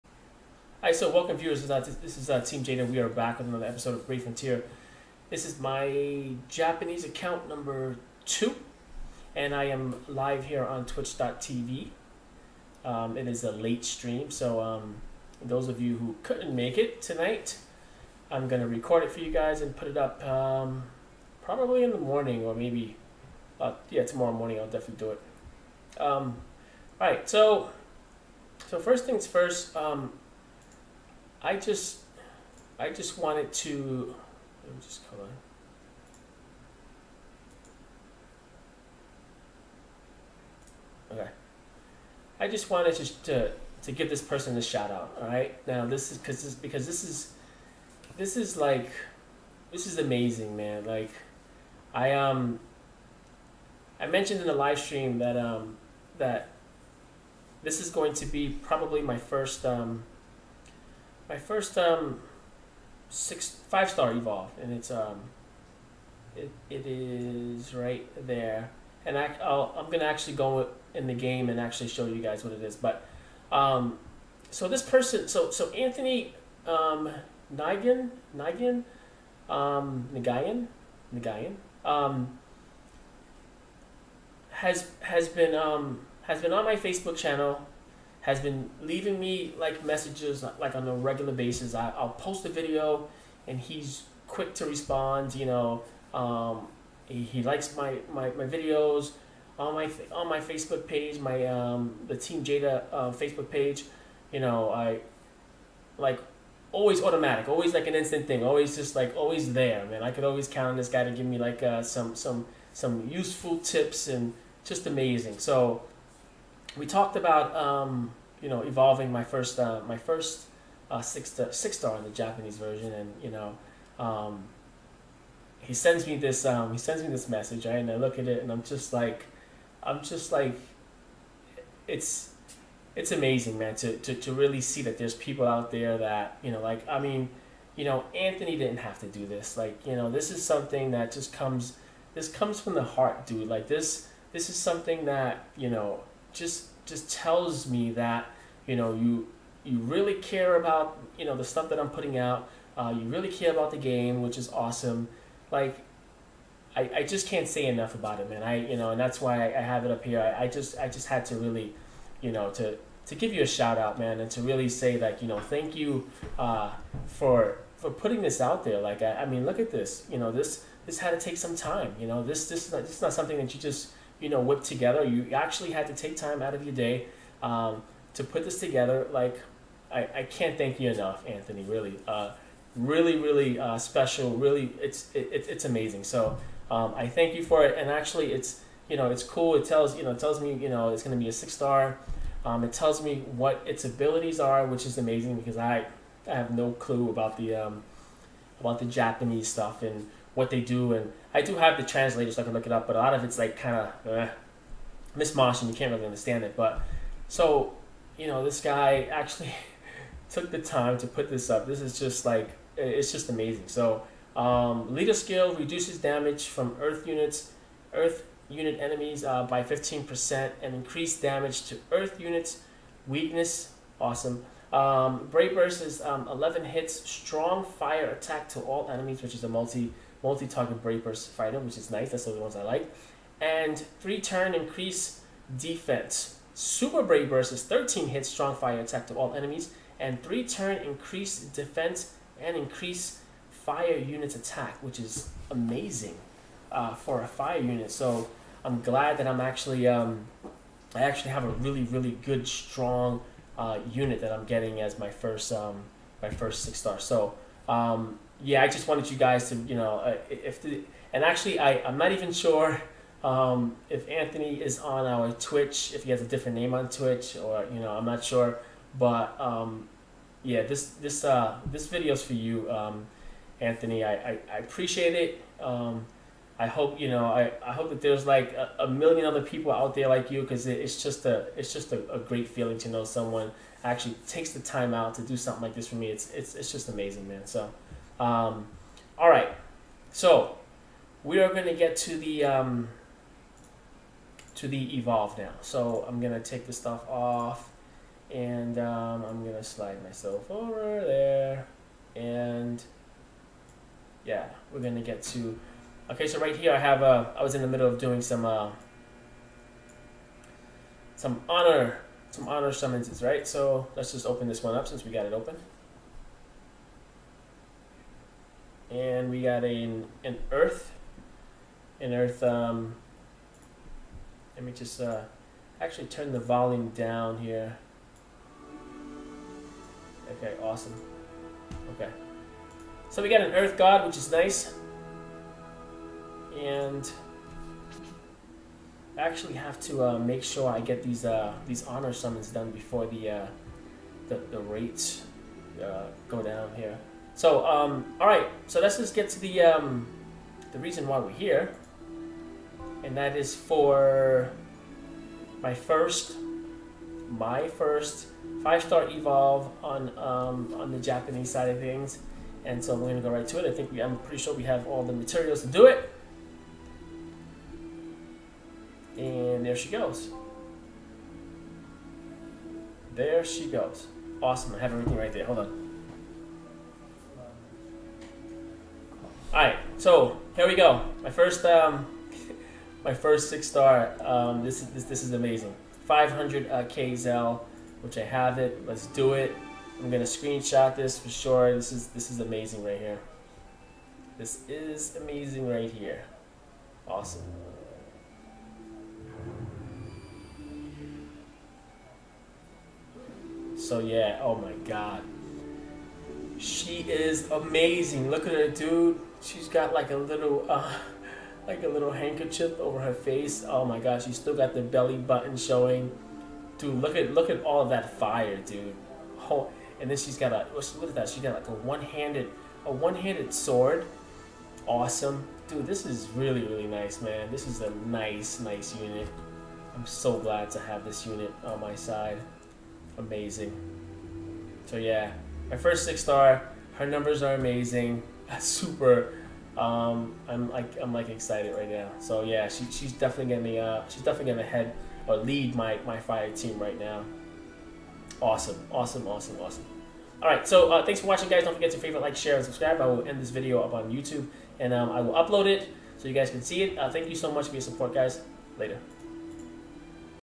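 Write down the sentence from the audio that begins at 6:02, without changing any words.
And so we're gonna go right to it.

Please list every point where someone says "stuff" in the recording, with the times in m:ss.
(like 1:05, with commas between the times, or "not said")
2:31, 3:19, 4:56.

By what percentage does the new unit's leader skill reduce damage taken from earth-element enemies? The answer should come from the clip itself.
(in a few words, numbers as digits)
15%.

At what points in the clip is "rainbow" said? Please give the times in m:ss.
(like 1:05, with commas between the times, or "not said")
not said.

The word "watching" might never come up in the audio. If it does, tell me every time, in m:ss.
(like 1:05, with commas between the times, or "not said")
7:31.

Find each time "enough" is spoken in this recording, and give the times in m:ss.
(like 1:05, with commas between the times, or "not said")
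2:37, 3:00.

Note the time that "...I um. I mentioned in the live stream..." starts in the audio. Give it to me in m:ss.
0:51.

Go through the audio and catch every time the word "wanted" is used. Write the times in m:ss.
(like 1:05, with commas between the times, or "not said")
0:33, 0:42, 4:18.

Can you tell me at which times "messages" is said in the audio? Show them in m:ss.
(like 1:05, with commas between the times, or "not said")
1:29, 2:07.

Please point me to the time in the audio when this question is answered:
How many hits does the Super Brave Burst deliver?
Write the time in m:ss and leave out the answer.
3:57.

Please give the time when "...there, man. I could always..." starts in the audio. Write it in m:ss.
1:49.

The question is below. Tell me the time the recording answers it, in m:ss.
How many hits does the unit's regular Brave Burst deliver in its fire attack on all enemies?
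3:46.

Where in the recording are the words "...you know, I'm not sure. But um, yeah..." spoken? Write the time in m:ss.
4:27.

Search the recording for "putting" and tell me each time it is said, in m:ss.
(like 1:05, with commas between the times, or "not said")
2:31, 2:47.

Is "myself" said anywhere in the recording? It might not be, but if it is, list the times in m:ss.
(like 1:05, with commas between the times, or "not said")
5:00.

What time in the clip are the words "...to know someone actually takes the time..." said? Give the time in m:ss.
4:42.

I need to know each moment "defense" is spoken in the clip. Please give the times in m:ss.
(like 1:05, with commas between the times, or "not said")
3:55, 4:01.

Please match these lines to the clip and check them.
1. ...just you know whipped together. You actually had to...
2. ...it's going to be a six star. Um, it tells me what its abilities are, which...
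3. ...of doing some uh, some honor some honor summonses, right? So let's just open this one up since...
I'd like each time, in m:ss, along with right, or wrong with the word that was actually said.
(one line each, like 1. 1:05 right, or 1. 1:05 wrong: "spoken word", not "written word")
1. 2:53 right
2. 3:10 right
3. 5:07 right.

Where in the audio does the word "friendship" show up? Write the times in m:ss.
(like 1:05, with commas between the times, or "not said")
not said.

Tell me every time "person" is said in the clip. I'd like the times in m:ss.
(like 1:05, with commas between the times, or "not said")
0:44, 1:14.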